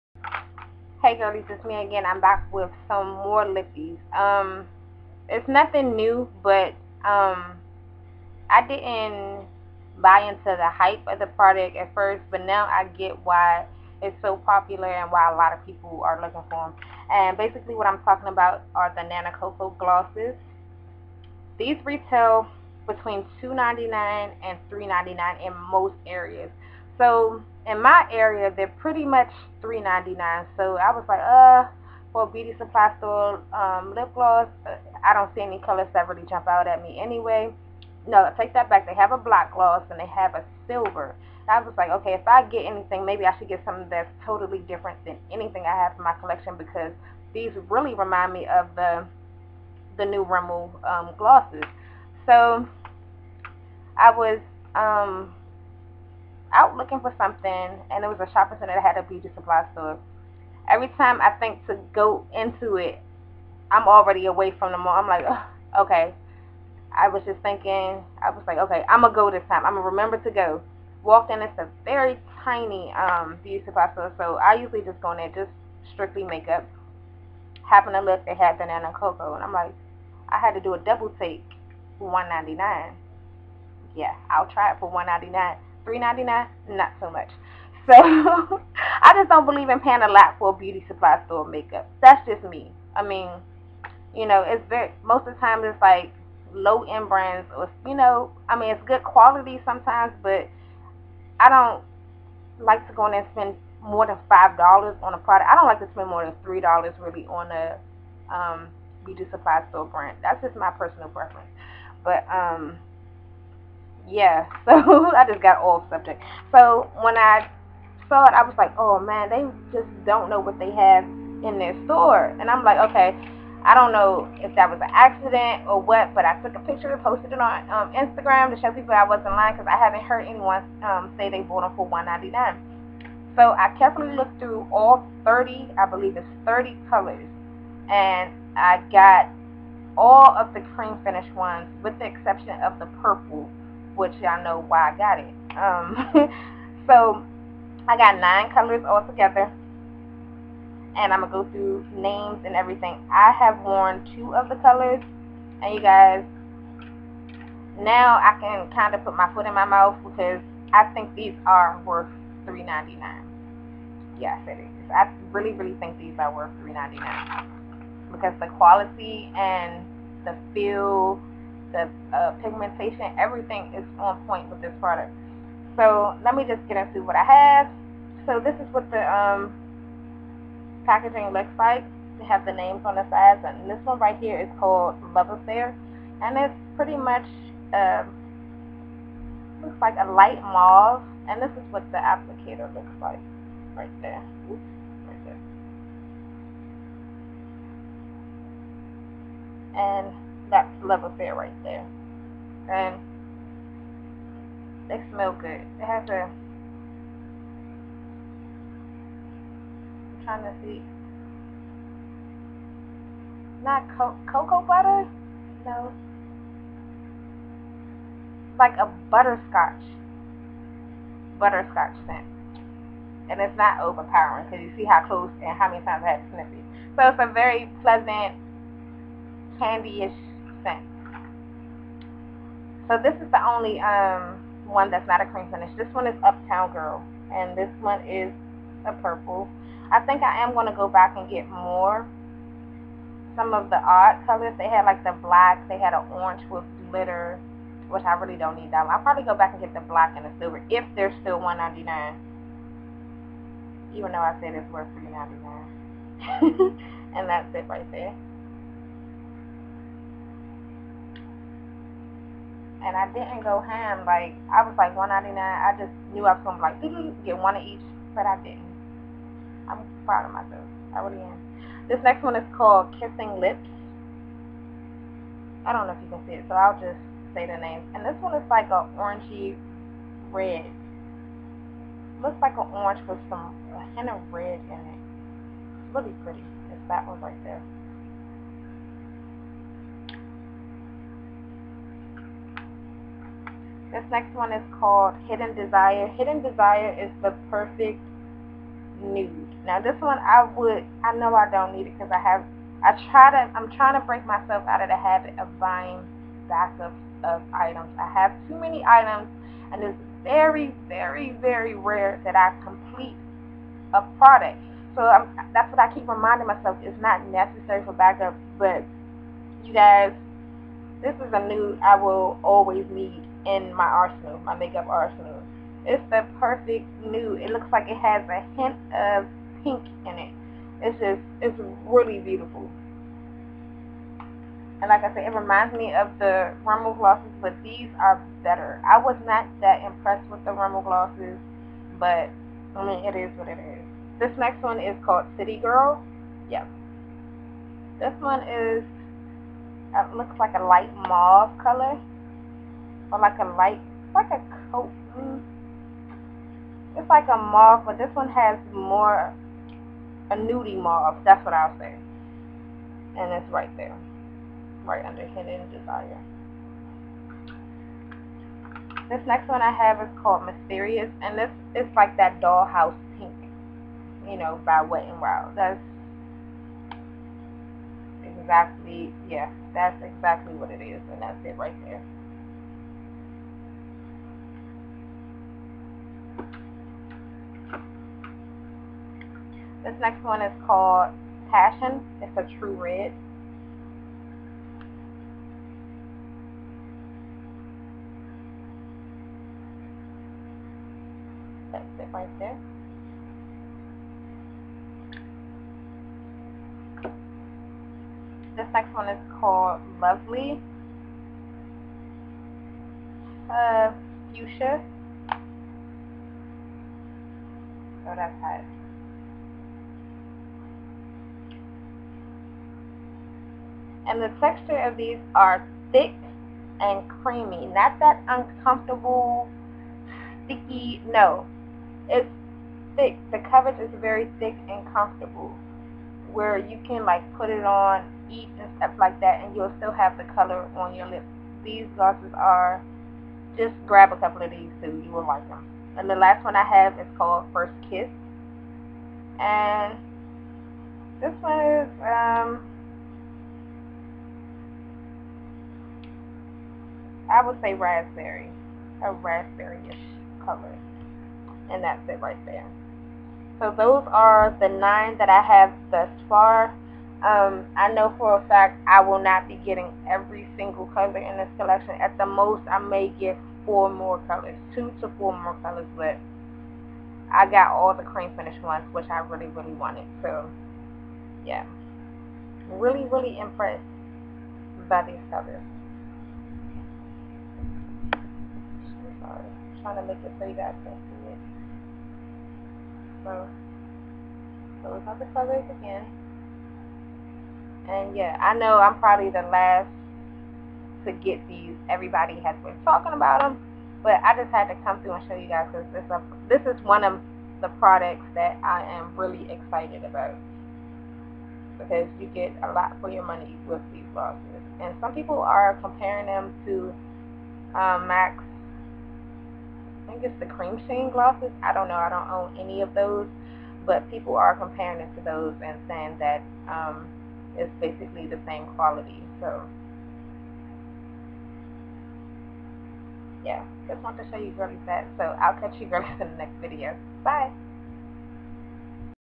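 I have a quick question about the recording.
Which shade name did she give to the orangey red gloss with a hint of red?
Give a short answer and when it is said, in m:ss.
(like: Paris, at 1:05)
Kissing Lips, at 4:32.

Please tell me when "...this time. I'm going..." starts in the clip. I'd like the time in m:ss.
1:09.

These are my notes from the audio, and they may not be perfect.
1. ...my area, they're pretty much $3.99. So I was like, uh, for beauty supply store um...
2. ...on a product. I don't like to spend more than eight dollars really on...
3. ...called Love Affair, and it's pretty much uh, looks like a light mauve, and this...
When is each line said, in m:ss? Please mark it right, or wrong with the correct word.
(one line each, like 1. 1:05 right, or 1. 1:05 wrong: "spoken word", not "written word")
1. 0:27 right
2. 1:45 wrong: "three", not "eight"
3. 3:04 right.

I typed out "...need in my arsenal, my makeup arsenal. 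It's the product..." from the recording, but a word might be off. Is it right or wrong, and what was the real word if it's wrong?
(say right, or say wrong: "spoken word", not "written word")
wrong: "perfect", not "product".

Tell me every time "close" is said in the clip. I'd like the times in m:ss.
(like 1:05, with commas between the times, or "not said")
3:45, 8:14.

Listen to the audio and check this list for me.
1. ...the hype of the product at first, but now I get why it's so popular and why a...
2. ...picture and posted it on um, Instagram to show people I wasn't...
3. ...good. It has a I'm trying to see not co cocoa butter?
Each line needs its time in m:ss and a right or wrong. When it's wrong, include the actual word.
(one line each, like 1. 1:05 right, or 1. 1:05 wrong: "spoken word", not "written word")
1. 0:10 right
2. 2:06 right
3. 3:25 right.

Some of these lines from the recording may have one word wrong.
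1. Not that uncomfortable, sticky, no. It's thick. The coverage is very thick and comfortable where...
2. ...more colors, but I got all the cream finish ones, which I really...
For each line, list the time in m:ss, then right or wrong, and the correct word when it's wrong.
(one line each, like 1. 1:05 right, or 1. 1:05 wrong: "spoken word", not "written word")
1. 7:07 right
2. 7:55 right.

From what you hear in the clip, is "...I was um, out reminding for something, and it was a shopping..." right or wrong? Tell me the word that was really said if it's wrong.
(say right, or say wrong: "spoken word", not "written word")
wrong: "looking", not "reminding".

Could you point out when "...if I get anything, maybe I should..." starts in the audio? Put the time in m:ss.
0:42.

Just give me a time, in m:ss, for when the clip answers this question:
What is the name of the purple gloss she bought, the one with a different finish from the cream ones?
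3:56.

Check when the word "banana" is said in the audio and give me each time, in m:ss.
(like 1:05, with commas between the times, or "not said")
1:18.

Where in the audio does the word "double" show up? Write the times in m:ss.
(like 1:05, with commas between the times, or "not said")
1:20.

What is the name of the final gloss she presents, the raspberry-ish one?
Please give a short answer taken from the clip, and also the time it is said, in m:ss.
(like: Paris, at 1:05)
First Kiss, at 7:27.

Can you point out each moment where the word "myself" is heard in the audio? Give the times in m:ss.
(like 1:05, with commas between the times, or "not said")
4:30, 5:04, 5:16.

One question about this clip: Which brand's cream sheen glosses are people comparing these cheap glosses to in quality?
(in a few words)
MAC.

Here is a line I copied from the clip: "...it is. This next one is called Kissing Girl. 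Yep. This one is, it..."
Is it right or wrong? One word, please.
wrong.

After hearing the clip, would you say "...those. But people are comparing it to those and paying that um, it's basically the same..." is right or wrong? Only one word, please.
wrong.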